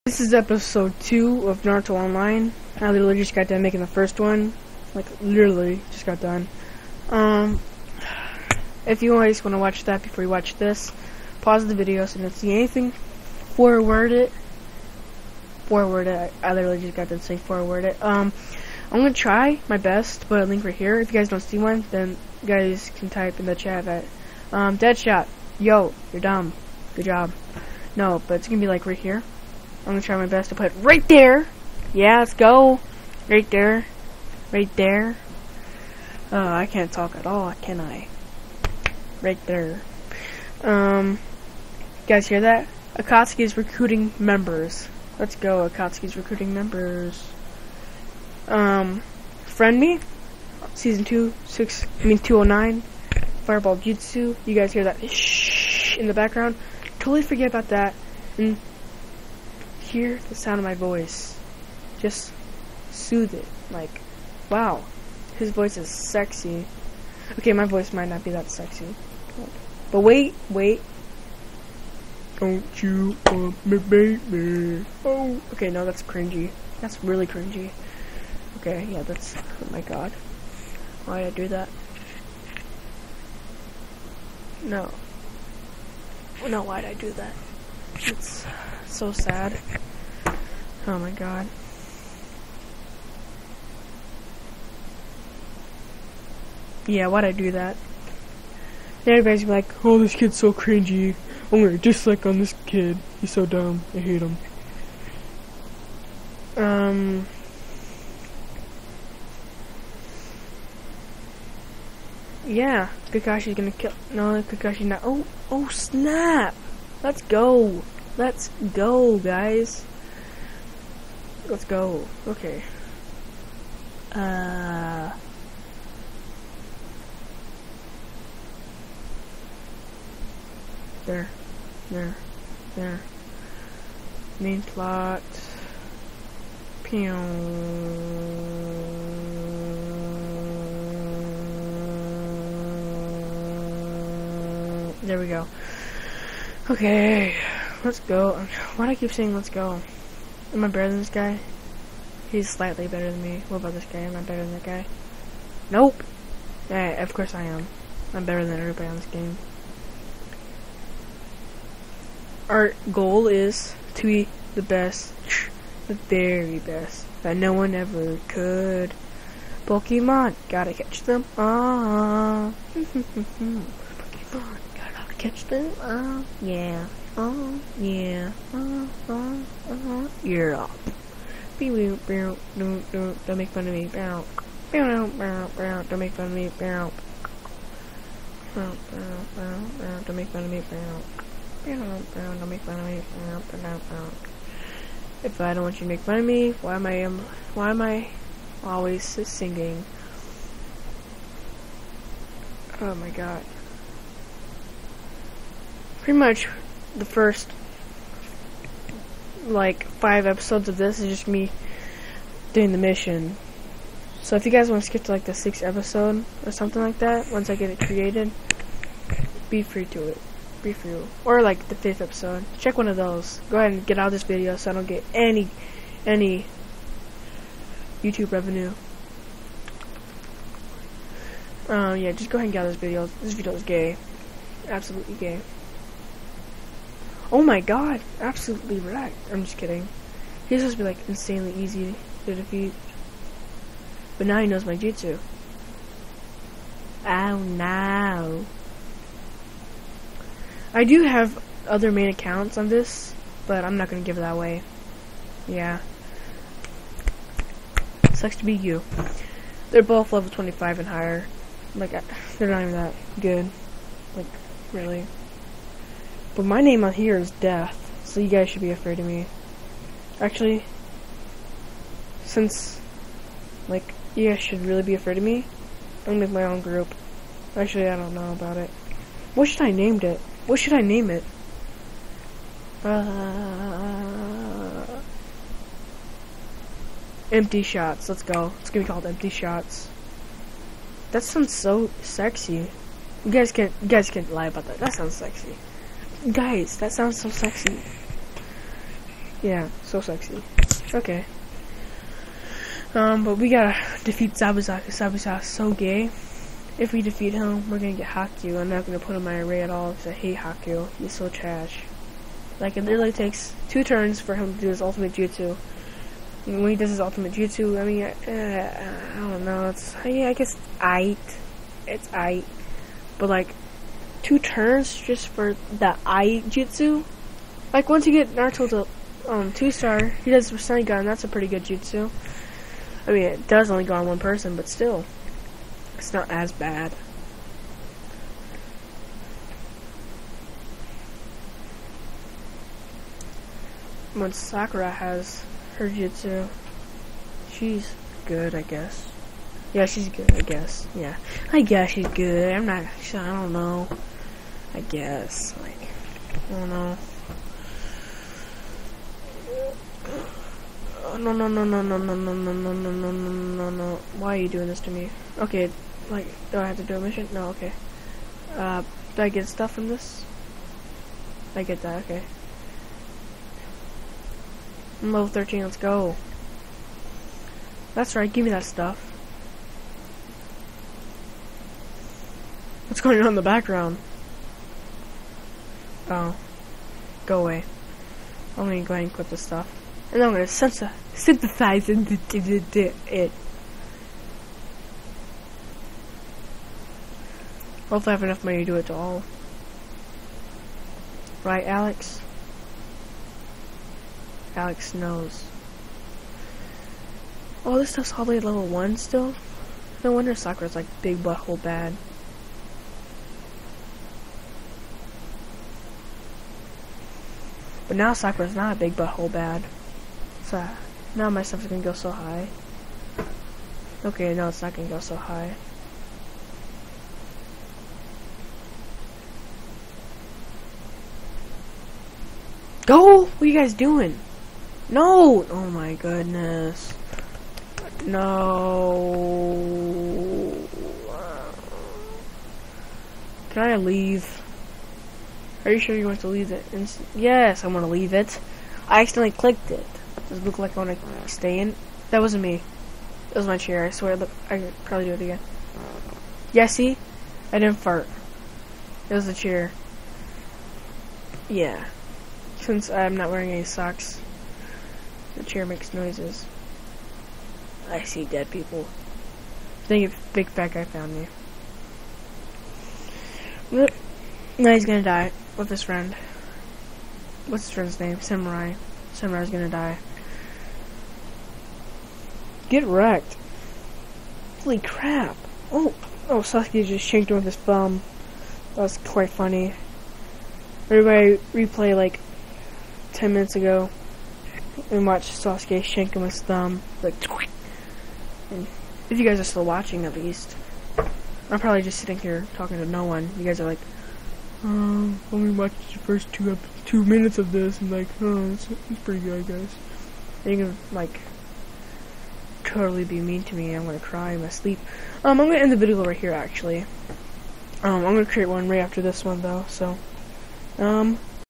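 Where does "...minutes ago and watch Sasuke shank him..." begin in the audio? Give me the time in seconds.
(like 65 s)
493 s.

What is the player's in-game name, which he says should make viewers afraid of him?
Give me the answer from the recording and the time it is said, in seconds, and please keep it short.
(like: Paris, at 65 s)
Death, at 267 s.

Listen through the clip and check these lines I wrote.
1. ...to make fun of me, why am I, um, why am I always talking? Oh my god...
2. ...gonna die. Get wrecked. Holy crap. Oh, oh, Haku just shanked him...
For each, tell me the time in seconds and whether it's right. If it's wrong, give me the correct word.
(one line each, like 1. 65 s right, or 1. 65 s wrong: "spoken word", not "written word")
1. 195 s wrong: "singing", not "talking"
2. 479 s wrong: "Sasuke", not "Haku".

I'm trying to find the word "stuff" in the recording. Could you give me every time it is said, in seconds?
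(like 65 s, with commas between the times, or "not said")
369 s, 378 s, 389 s, 407 s, 421 s.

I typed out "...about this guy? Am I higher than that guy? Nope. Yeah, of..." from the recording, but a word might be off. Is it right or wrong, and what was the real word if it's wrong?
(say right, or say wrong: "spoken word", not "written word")
wrong: "better", not "higher".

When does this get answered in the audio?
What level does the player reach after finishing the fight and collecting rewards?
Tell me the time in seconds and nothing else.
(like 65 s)
375 s.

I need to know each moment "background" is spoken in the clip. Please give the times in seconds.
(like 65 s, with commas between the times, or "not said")
56 s, 383 s.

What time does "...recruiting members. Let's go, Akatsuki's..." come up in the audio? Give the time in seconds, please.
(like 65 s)
43 s.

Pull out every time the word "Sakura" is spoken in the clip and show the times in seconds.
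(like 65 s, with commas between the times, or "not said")
344 s, 410 s, 418 s.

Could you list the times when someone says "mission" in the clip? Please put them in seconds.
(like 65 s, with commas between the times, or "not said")
212 s, 367 s.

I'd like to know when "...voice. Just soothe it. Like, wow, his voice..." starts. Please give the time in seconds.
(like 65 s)
60 s.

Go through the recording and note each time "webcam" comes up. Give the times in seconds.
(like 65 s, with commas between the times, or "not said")
not said.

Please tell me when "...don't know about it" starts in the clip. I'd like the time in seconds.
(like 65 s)
277 s.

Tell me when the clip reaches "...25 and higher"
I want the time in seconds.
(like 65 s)
260 s.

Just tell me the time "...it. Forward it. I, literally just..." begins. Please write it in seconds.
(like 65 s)
14 s.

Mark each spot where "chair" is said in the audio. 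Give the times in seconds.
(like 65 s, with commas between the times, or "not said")
453 s, 459 s, 465 s.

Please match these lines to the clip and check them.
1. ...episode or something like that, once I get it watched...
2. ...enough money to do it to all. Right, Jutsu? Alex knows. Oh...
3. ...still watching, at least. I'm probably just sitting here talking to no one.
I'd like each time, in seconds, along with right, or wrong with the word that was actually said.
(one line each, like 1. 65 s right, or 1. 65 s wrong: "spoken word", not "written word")
1. 215 s wrong: "created", not "watched"
2. 398 s wrong: "Alex", not "Jutsu"
3. 499 s right.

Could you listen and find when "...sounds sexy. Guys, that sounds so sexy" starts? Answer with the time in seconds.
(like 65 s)
294 s.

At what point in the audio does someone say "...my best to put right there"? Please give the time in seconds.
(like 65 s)
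30 s.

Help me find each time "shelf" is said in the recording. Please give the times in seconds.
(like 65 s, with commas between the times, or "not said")
not said.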